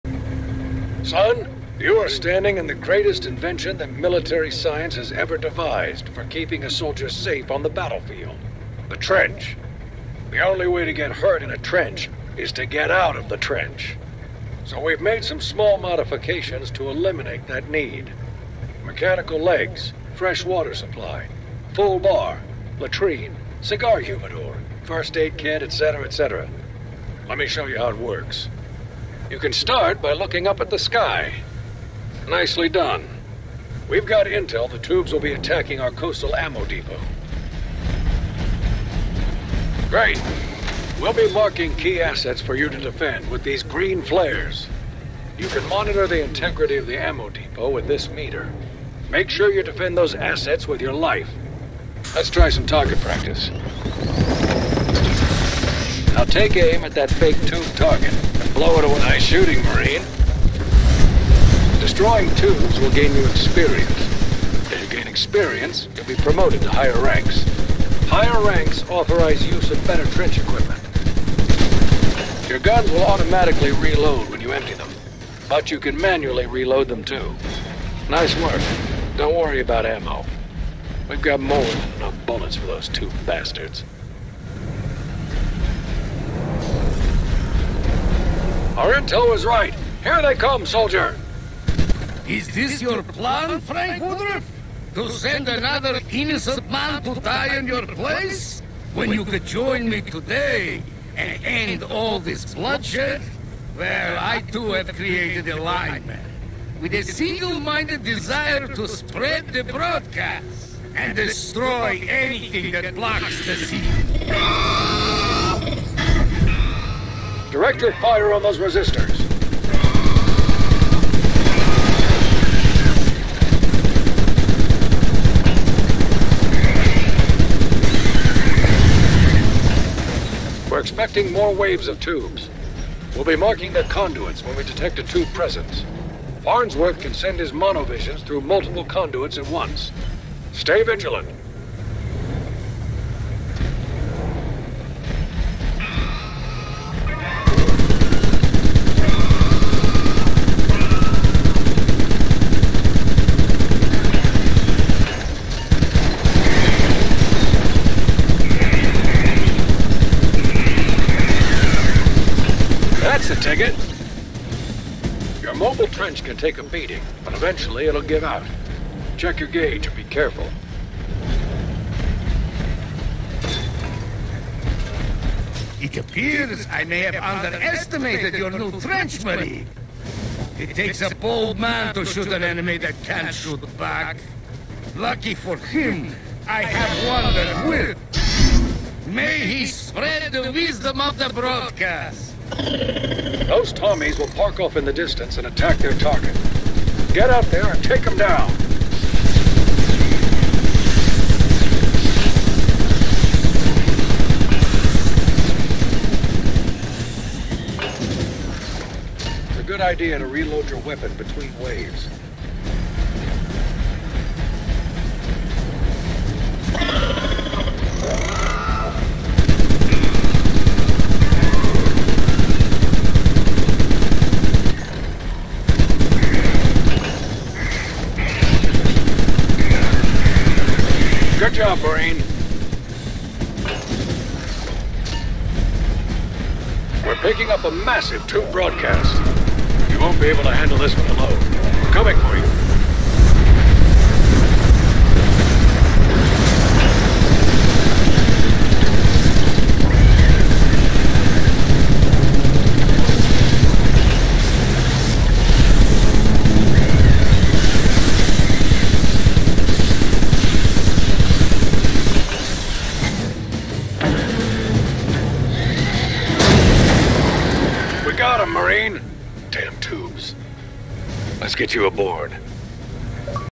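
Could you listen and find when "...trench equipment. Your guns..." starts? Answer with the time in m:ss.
1:10.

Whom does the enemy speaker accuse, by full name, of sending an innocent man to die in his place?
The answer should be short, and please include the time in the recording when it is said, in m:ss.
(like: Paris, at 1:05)
Frank Woodruff, at 1:33.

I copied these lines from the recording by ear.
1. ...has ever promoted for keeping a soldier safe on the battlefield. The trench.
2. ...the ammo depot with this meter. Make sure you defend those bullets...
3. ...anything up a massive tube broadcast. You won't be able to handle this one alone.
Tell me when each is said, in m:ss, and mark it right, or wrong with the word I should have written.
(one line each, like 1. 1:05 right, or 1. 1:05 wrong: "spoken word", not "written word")
1. 0:04 wrong: "devised", not "promoted"
2. 0:46 wrong: "assets", not "bullets"
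3. 3:57 wrong: "picking", not "anything".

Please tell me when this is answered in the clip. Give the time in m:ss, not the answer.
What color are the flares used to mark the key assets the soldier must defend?
0:43.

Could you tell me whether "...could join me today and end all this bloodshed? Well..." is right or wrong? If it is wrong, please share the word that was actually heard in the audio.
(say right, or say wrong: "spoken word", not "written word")
right.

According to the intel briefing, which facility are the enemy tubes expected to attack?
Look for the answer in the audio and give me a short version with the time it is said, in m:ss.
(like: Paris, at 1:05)
Coastal ammo depot, at 0:35.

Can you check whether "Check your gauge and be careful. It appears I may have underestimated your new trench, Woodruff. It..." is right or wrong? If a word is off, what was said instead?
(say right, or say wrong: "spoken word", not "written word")
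wrong: "Marie", not "Woodruff".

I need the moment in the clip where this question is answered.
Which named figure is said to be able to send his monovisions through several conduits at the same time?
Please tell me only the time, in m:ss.
2:16.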